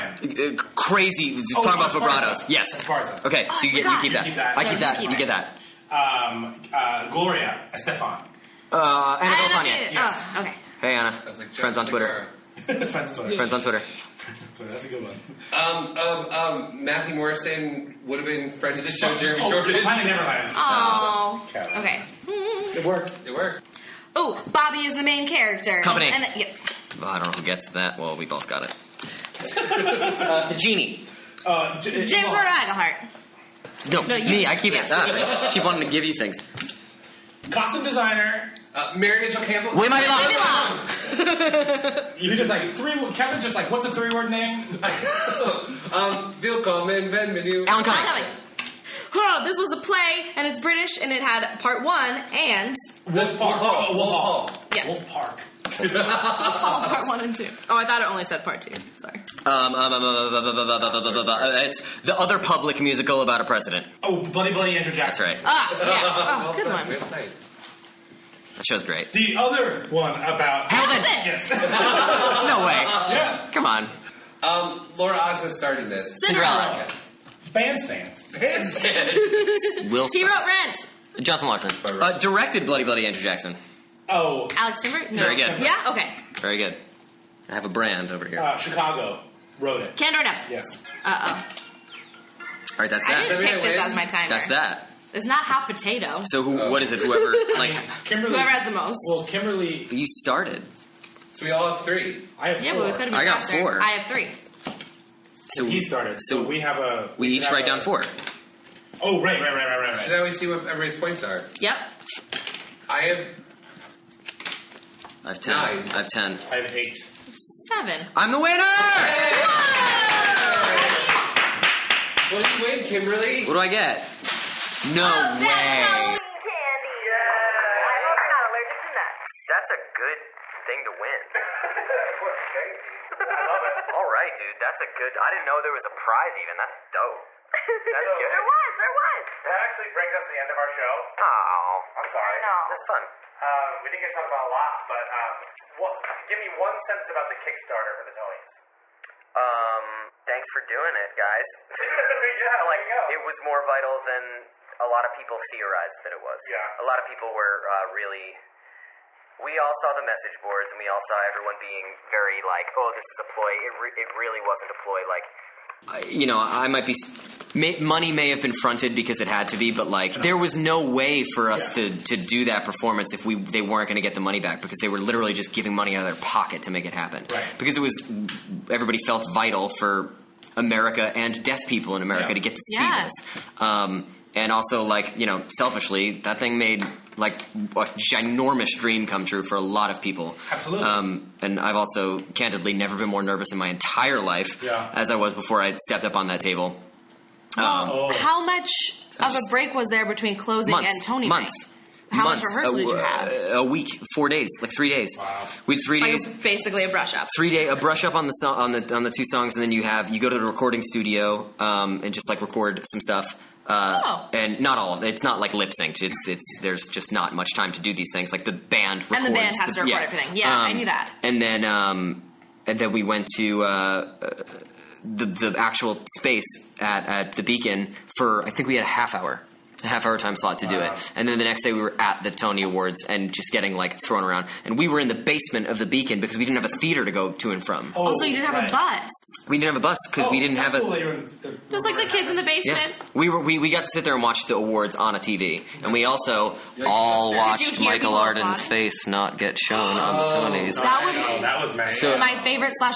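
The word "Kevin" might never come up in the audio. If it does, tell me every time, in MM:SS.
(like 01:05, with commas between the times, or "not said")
00:43.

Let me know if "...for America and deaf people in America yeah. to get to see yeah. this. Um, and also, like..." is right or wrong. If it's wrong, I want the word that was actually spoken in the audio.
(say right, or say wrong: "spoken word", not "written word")
right.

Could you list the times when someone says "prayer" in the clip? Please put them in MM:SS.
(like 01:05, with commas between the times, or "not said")
not said.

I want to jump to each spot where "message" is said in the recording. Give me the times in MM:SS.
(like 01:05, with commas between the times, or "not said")
02:40.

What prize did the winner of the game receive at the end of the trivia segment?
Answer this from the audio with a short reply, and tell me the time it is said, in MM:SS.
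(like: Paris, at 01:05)
Halloween candy, at 02:05.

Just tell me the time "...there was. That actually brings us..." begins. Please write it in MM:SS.
02:18.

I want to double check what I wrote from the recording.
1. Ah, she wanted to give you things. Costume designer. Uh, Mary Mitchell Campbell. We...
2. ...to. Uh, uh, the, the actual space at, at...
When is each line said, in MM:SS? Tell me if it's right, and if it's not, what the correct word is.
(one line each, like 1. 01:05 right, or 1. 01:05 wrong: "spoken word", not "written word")
1. 00:34 right
2. 03:43 right.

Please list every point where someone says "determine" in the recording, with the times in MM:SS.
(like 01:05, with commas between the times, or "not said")
not said.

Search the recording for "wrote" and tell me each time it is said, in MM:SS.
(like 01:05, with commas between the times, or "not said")
01:20, 01:29.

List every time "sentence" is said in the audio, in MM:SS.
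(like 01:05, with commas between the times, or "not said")
02:26.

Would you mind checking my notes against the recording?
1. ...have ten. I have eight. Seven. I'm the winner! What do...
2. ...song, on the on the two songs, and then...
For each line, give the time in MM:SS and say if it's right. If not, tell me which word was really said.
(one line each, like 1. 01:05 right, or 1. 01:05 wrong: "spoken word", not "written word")
1. 01:55 right
2. 03:28 right.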